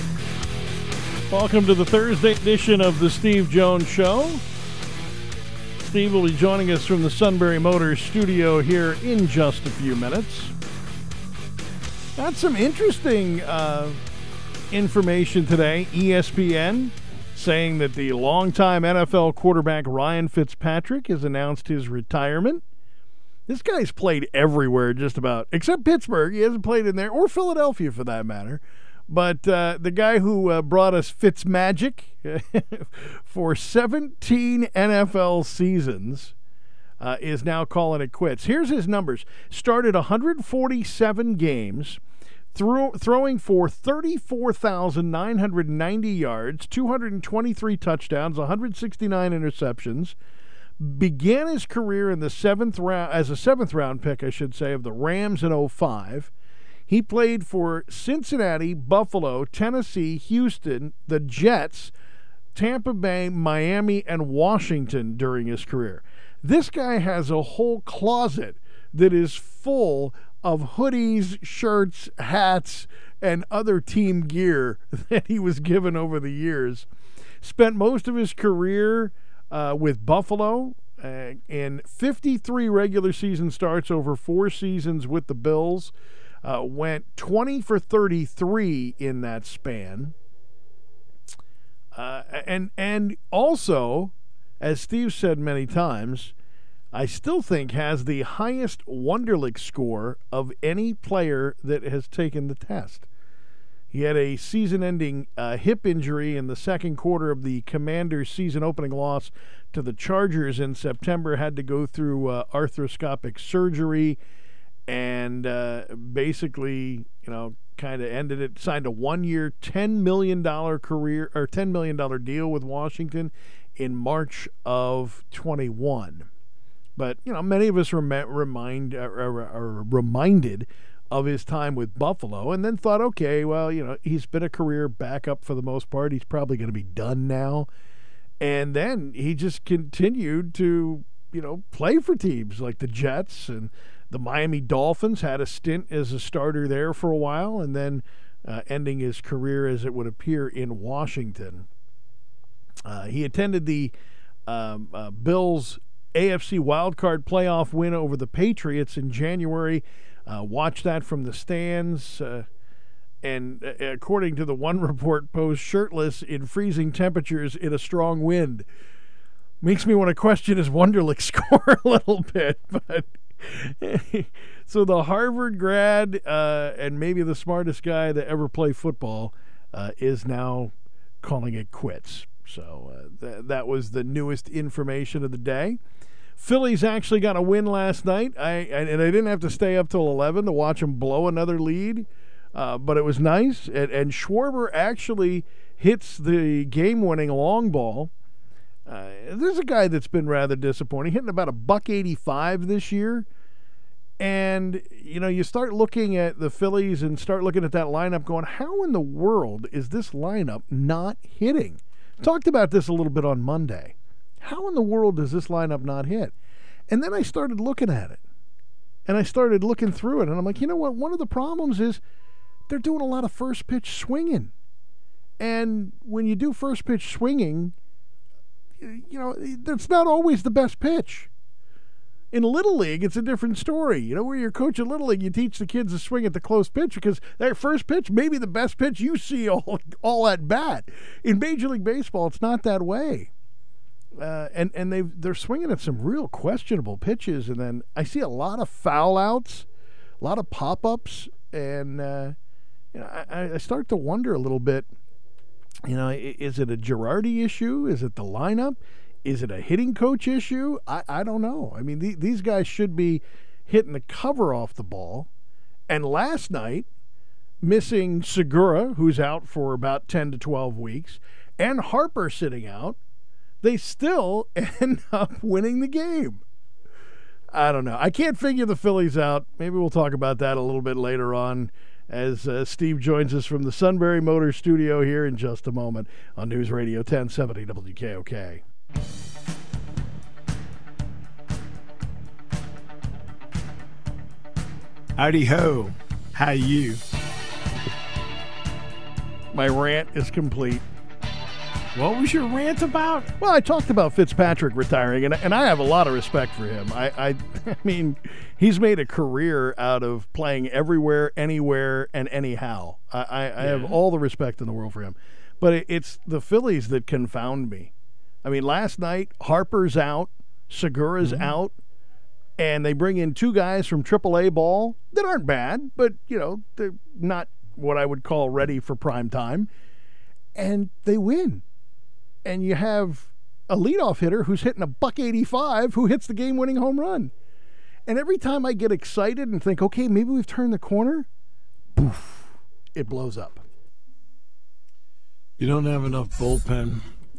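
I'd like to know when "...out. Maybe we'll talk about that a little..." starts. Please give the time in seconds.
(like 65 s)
279 s.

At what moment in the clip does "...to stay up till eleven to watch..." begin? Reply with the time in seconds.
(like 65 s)
189 s.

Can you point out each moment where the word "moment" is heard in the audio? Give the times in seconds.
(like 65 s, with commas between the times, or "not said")
285 s.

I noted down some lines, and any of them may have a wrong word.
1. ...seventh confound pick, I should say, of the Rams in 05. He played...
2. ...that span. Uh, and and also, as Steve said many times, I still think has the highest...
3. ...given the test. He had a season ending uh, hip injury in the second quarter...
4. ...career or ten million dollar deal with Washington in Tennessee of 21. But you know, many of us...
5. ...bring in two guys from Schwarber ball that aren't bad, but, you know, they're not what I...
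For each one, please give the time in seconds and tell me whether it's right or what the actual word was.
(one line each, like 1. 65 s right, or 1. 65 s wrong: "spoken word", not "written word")
1. 53 s wrong: "round", not "confound"
2. 89 s right
3. 102 s wrong: "taken", not "given"
4. 120 s wrong: "March", not "Tennessee"
5. 322 s wrong: "AAA", not "Schwarber".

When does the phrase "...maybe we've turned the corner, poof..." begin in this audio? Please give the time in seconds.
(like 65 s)
340 s.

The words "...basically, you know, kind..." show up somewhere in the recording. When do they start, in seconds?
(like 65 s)
115 s.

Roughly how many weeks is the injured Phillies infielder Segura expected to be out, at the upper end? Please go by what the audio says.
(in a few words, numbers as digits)
12 weeks.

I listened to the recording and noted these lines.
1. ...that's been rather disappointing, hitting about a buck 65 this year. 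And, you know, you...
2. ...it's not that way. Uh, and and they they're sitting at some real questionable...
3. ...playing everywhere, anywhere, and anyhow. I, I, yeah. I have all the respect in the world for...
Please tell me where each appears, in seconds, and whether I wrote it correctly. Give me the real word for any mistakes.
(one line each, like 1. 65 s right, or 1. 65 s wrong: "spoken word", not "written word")
1. 199 s wrong: "85", not "65"
2. 242 s wrong: "swinging", not "sitting"
3. 310 s right.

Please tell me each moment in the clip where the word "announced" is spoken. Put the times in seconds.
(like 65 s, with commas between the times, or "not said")
21 s.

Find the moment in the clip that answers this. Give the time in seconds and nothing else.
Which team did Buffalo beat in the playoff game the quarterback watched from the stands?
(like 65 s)
158 s.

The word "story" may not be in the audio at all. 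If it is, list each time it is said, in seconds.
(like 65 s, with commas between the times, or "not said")
233 s.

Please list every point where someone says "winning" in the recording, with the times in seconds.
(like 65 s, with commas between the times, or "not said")
196 s, 275 s, 336 s.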